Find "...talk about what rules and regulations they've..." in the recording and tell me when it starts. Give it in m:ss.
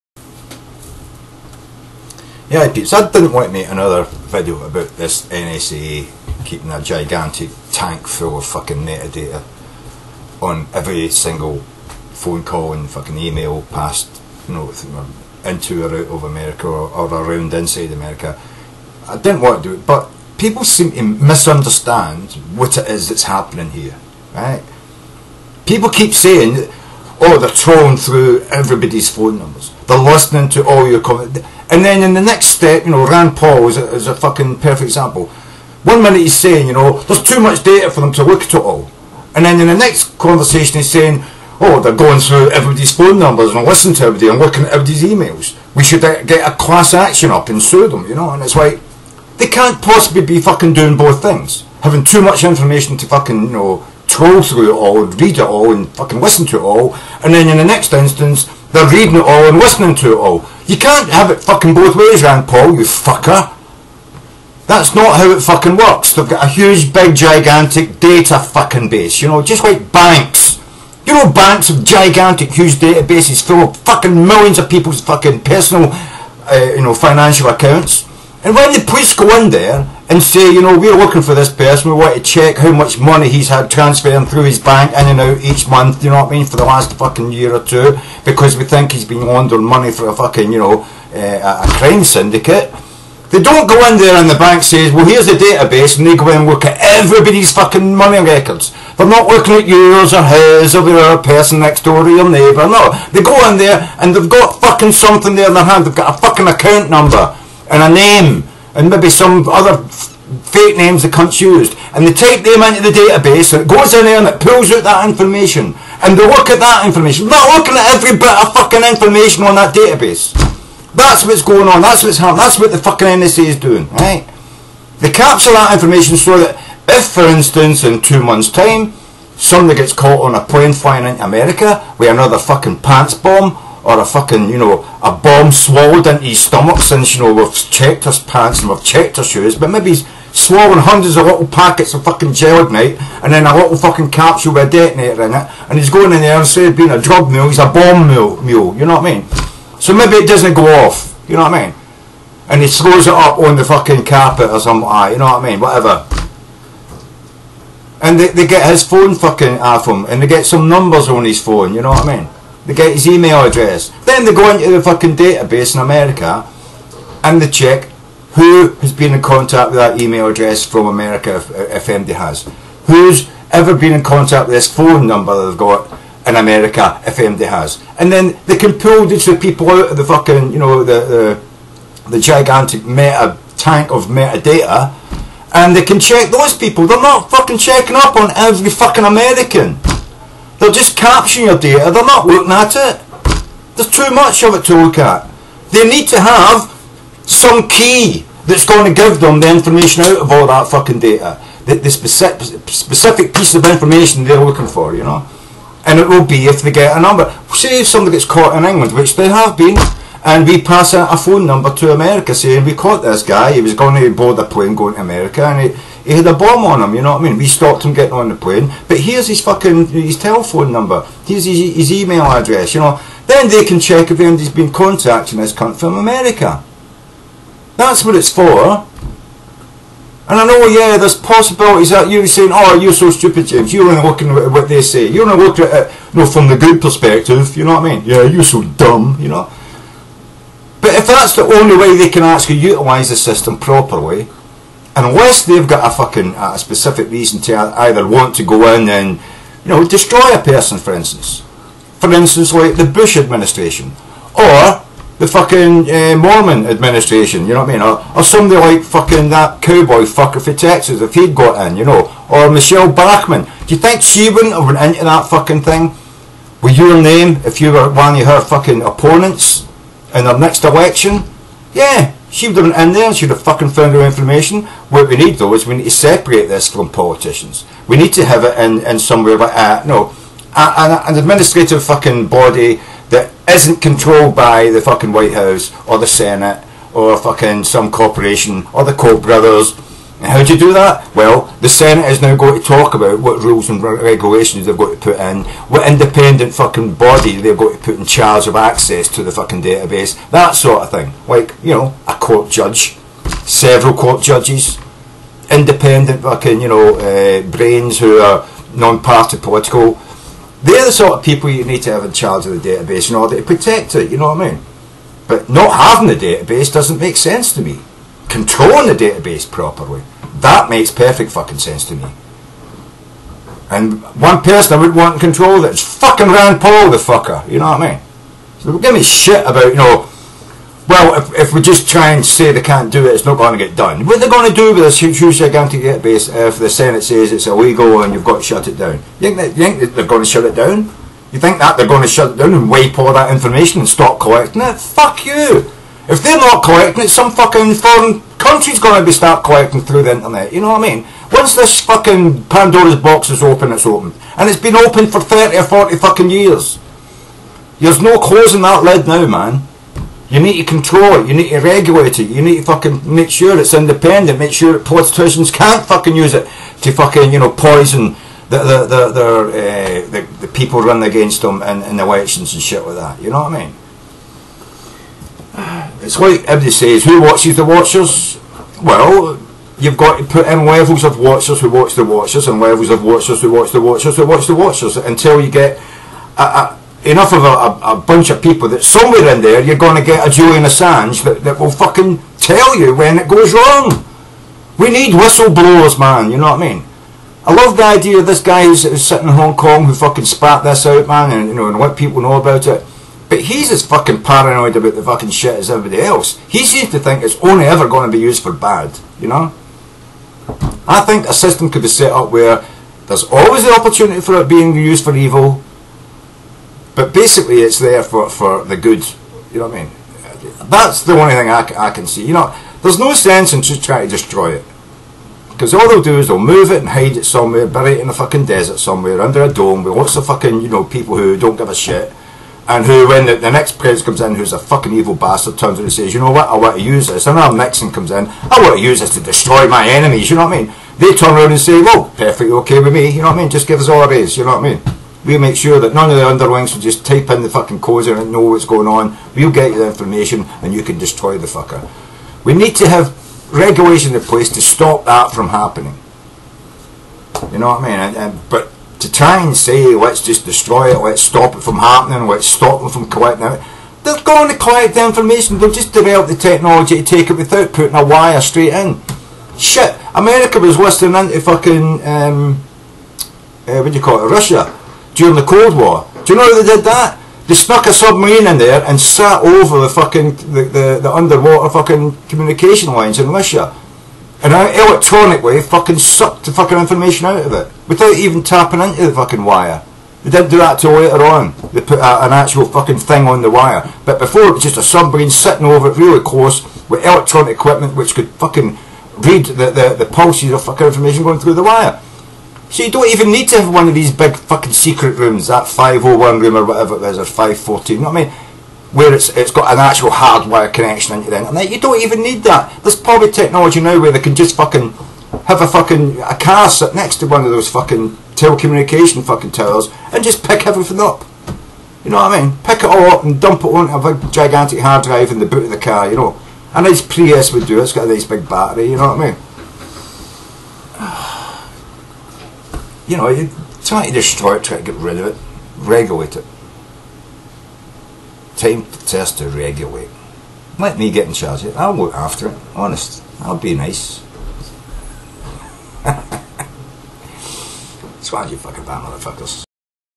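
4:52.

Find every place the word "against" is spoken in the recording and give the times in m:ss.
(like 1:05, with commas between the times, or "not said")
6:11.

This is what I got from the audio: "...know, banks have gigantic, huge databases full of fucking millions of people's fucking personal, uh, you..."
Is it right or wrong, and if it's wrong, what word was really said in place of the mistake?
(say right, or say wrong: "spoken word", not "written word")
right.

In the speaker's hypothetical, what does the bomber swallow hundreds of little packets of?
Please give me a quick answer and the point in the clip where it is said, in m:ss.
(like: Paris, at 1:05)
gelignite, at 2:22.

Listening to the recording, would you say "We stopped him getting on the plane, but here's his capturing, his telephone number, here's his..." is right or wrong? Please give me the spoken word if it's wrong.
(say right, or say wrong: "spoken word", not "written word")
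wrong: "fucking", not "capturing".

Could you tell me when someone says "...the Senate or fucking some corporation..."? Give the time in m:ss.
4:45.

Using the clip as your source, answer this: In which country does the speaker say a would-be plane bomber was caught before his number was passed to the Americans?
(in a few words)
England.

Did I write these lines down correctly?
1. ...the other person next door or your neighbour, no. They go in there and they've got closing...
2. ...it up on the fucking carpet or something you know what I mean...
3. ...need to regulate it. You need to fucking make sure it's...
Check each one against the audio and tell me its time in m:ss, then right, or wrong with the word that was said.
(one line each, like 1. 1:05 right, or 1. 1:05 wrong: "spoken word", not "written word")
1. 1:40 wrong: "fucking", not "closing"
2. 2:33 right
3. 6:01 right.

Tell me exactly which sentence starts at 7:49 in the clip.
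Shit, America was listening into fucking, um, uh, what do you call it, Russia during the Cold War.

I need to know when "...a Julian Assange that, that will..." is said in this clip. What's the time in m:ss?
6:30.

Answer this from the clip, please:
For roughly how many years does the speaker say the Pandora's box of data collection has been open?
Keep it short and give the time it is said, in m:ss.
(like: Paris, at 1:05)
30 or 40, at 5:55.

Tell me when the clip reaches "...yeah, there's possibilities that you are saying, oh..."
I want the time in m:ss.
3:50.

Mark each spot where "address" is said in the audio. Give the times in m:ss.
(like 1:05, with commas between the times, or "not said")
2:43, 2:50, 3:42.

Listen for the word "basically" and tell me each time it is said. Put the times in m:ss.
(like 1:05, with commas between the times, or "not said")
6:57.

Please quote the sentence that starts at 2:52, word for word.
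Who's ever been in contact with this phone number they've got in America if MD has.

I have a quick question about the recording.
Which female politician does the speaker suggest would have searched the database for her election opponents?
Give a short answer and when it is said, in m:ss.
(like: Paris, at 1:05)
Michele Bachmann, at 4:22.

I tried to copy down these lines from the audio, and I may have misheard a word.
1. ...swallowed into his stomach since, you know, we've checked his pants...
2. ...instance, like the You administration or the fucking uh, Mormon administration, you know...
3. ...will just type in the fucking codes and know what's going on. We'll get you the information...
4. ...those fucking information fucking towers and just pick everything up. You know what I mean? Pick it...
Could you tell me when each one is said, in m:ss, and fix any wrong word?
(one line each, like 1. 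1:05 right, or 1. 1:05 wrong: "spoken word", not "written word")
1. 2:15 right
2. 4:12 wrong: "Bush", not "You"
3. 7:26 right
4. 8:37 wrong: "telecommunication", not "information".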